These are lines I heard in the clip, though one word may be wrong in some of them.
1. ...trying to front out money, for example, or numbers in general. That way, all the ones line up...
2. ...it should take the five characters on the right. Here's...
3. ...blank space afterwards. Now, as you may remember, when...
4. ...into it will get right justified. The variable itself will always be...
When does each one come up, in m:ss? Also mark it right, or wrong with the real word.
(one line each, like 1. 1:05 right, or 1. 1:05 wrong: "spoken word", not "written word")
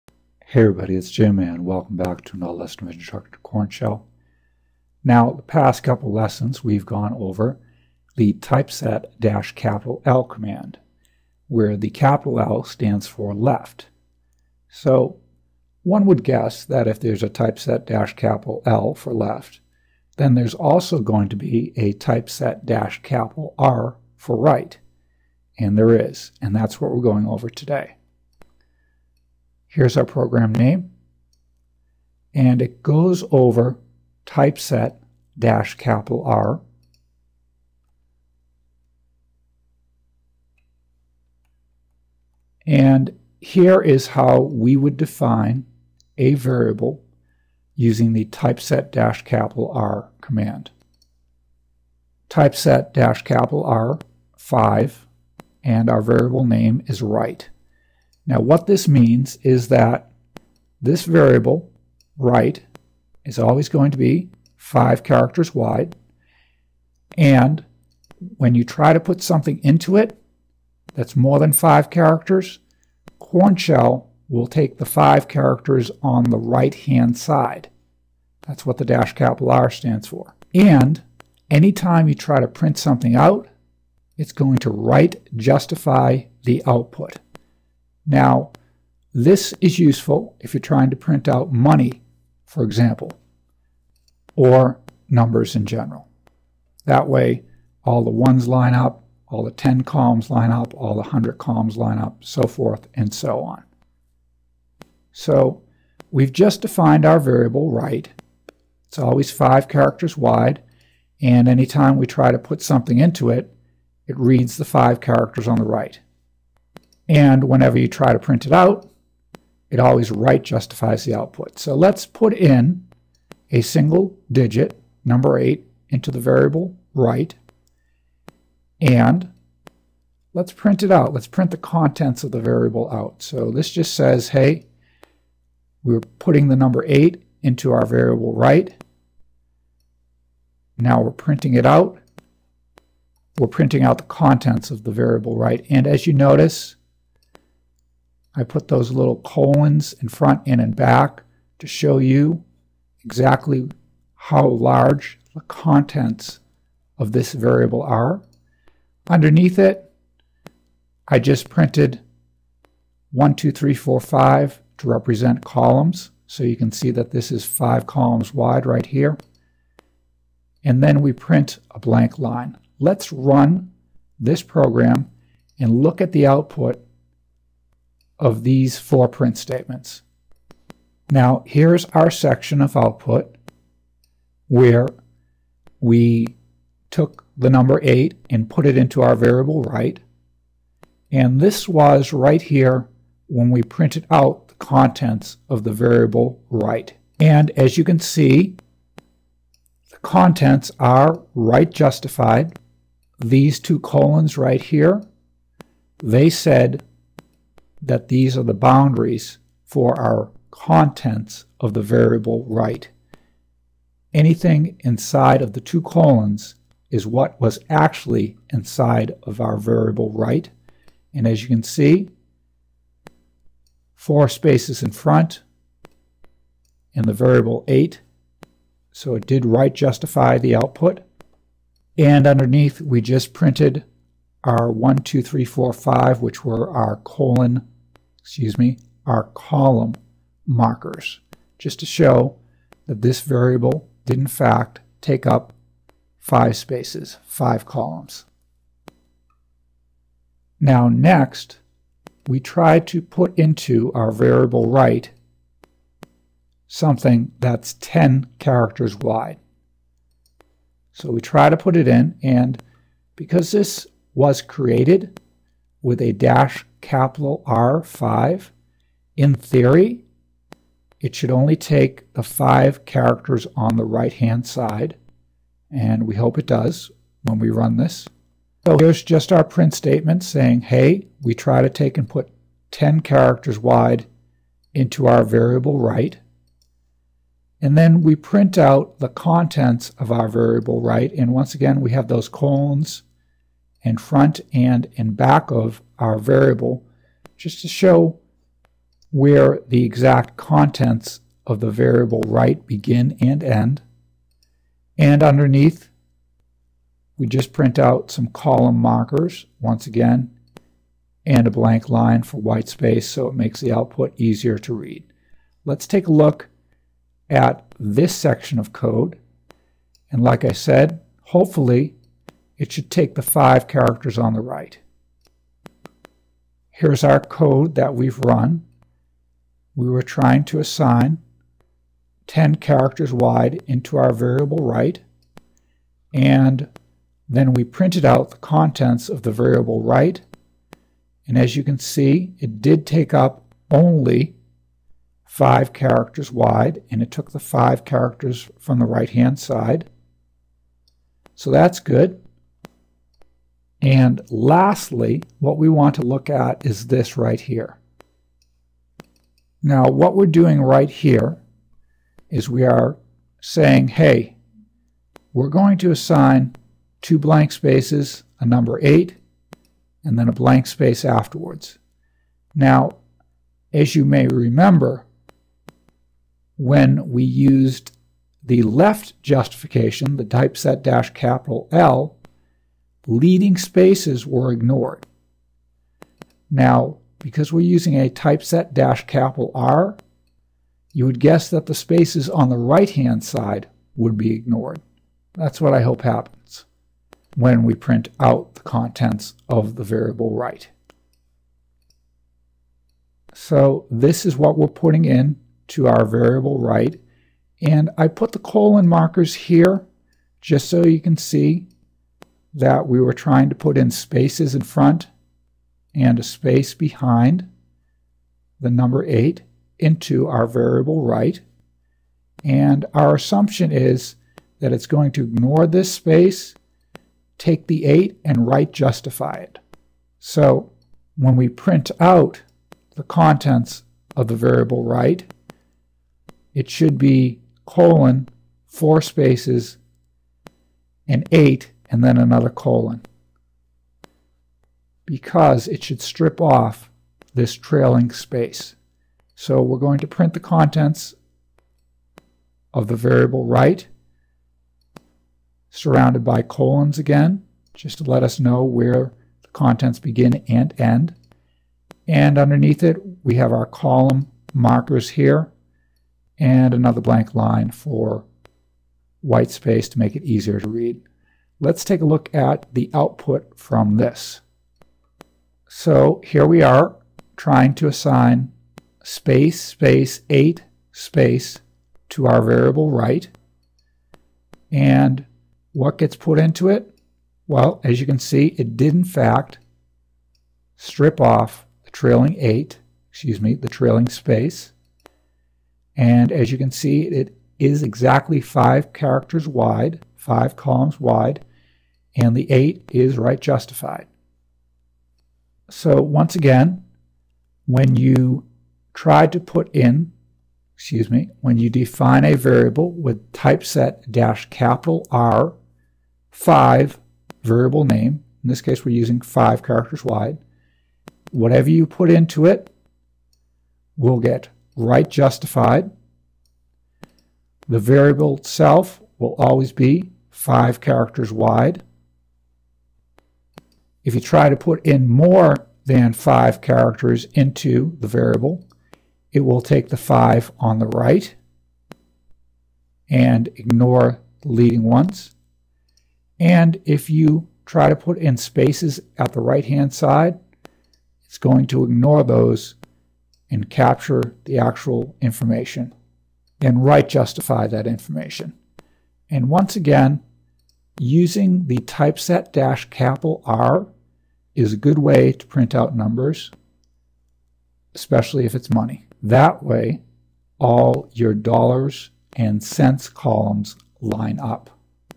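1. 1:30 wrong: "print", not "front"
2. 5:22 right
3. 6:10 right
4. 8:42 right.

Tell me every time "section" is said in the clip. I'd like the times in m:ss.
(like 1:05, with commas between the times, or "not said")
3:02, 5:18.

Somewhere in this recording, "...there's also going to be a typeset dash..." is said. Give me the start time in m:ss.
0:20.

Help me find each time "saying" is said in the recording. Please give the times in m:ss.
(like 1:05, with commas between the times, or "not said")
4:40, 6:03.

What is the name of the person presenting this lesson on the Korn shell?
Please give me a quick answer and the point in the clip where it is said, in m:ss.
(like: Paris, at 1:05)
Jim, at 0:01.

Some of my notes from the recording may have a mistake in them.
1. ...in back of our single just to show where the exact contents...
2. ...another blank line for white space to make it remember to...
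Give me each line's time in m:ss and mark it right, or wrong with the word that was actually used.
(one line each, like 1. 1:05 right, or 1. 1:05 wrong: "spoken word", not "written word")
1. 4:54 wrong: "variable", not "single"
2. 7:46 wrong: "easier", not "remember".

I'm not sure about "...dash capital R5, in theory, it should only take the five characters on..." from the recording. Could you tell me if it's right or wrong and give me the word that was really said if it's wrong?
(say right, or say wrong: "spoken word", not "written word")
right.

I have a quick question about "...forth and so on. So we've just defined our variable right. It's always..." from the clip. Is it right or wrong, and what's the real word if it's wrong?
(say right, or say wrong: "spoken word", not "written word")
right.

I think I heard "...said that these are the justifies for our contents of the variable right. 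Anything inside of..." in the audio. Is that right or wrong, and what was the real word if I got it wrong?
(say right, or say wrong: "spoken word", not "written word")
wrong: "boundaries", not "justifies".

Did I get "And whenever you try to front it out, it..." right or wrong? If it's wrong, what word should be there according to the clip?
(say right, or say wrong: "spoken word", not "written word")
wrong: "print", not "front".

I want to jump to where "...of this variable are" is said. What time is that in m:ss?
2:36.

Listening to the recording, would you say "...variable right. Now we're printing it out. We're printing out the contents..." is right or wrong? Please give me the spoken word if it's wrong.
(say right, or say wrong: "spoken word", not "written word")
right.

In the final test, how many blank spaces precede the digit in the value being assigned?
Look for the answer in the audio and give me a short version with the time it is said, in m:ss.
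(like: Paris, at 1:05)
2, at 6:07.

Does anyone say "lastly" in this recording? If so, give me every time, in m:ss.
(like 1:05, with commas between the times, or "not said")
5:54.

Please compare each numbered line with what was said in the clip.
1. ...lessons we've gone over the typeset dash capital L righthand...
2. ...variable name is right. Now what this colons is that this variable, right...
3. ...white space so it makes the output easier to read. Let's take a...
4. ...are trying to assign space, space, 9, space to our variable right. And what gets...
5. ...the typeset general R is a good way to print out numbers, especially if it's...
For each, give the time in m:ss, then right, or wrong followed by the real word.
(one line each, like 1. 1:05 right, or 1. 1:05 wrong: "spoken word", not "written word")
1. 0:06 wrong: "command", not "righthand"
2. 0:56 wrong: "means", not "colons"
3. 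5:12 right
4. 7:56 wrong: "8", not "9"
5. 9:21 wrong: "capital", not "general".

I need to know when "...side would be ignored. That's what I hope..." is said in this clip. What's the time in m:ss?
6:33.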